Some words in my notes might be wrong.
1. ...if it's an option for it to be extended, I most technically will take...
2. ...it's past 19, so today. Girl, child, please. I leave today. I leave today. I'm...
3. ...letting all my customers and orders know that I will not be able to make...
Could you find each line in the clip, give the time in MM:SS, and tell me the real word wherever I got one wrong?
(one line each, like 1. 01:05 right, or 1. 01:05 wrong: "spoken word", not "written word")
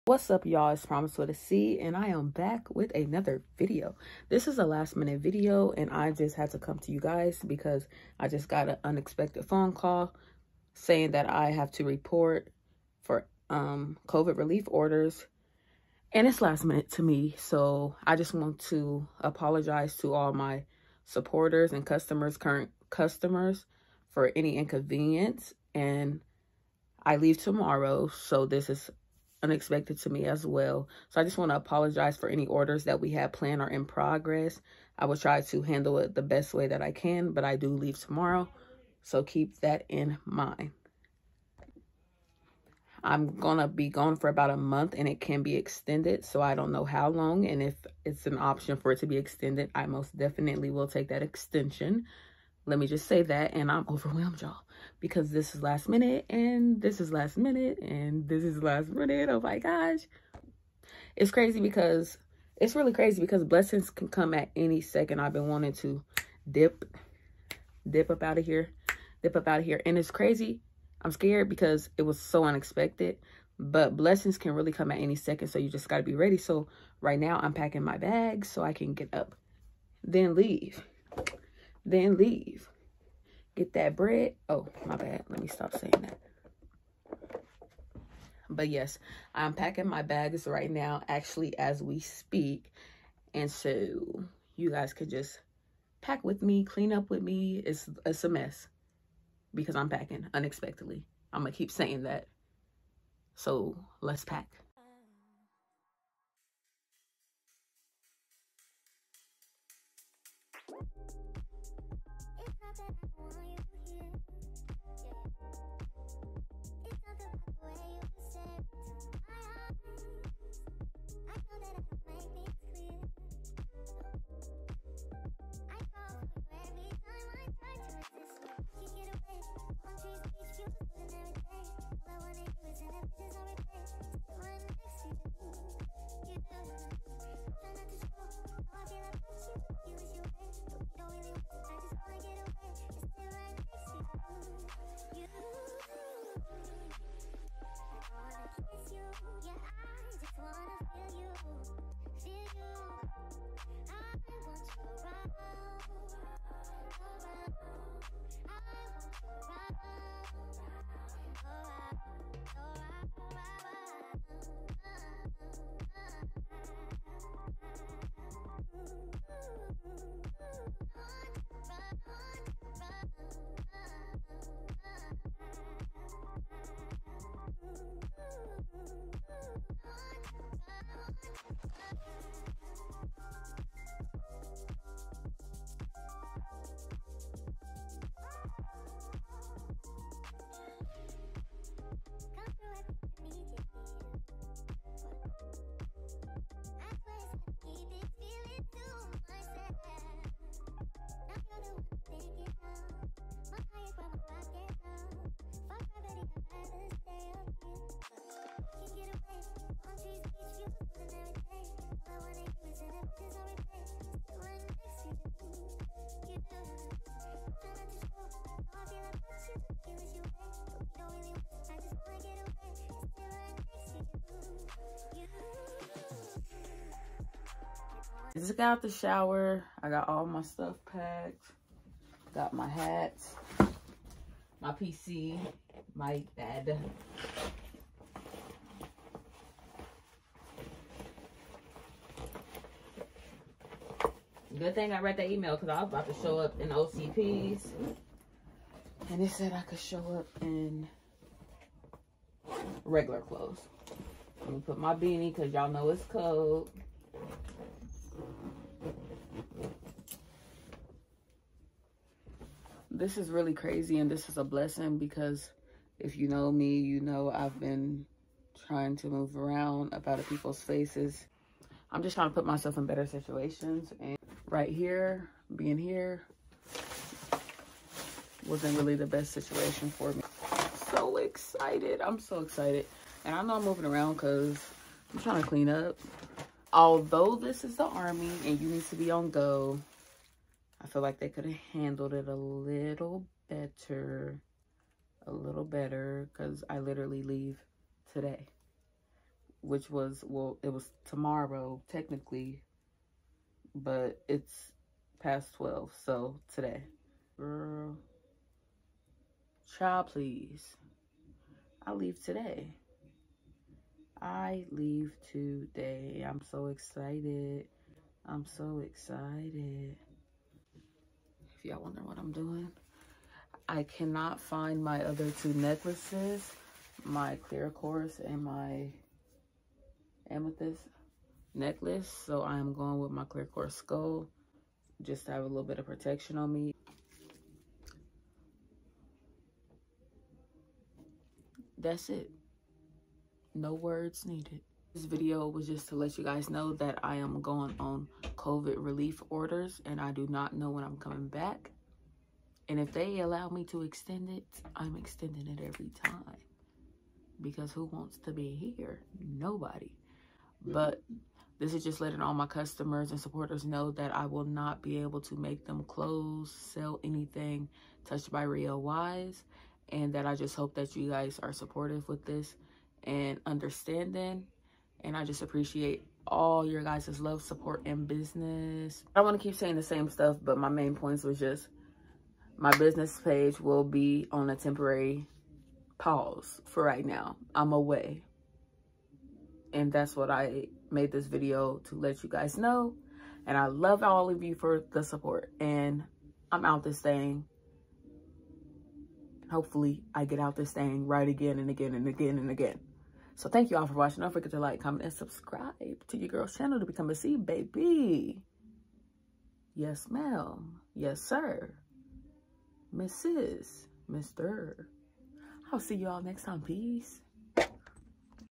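1. 00:47 wrong: "definitely", not "technically"
2. 05:04 wrong: "12", not "19"
3. 06:02 wrong: "supporters", not "orders".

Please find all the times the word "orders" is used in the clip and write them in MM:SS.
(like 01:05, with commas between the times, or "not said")
00:14, 00:32, 05:49.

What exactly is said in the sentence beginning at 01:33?
And so you guys could just pack with me, clean up with me.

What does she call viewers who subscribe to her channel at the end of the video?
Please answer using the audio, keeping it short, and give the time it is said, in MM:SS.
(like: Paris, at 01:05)
C baby, at 06:47.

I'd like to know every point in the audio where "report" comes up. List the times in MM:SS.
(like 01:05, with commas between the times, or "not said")
00:11.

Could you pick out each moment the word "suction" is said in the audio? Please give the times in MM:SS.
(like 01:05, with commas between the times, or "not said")
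not said.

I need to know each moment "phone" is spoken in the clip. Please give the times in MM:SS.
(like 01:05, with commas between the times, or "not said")
00:09.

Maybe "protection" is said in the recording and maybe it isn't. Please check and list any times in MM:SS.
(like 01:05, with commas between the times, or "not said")
05:35.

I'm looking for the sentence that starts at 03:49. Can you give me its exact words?
I got all my stuff packed.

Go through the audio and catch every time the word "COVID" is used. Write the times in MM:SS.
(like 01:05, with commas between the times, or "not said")
00:14, 05:48.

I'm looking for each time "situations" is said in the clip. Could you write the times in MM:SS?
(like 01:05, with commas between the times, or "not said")
04:33, 04:39.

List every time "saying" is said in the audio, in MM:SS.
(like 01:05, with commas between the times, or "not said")
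00:10, 01:25, 01:41, 06:19.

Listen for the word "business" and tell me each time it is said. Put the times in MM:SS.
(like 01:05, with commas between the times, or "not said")
06:18, 06:22.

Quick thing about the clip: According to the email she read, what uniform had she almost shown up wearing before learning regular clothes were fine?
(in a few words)
OCPs.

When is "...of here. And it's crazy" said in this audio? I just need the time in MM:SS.
01:09.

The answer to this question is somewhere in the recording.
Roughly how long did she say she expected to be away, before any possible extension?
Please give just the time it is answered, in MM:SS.
00:44.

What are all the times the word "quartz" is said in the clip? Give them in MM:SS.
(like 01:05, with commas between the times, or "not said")
05:27, 05:33.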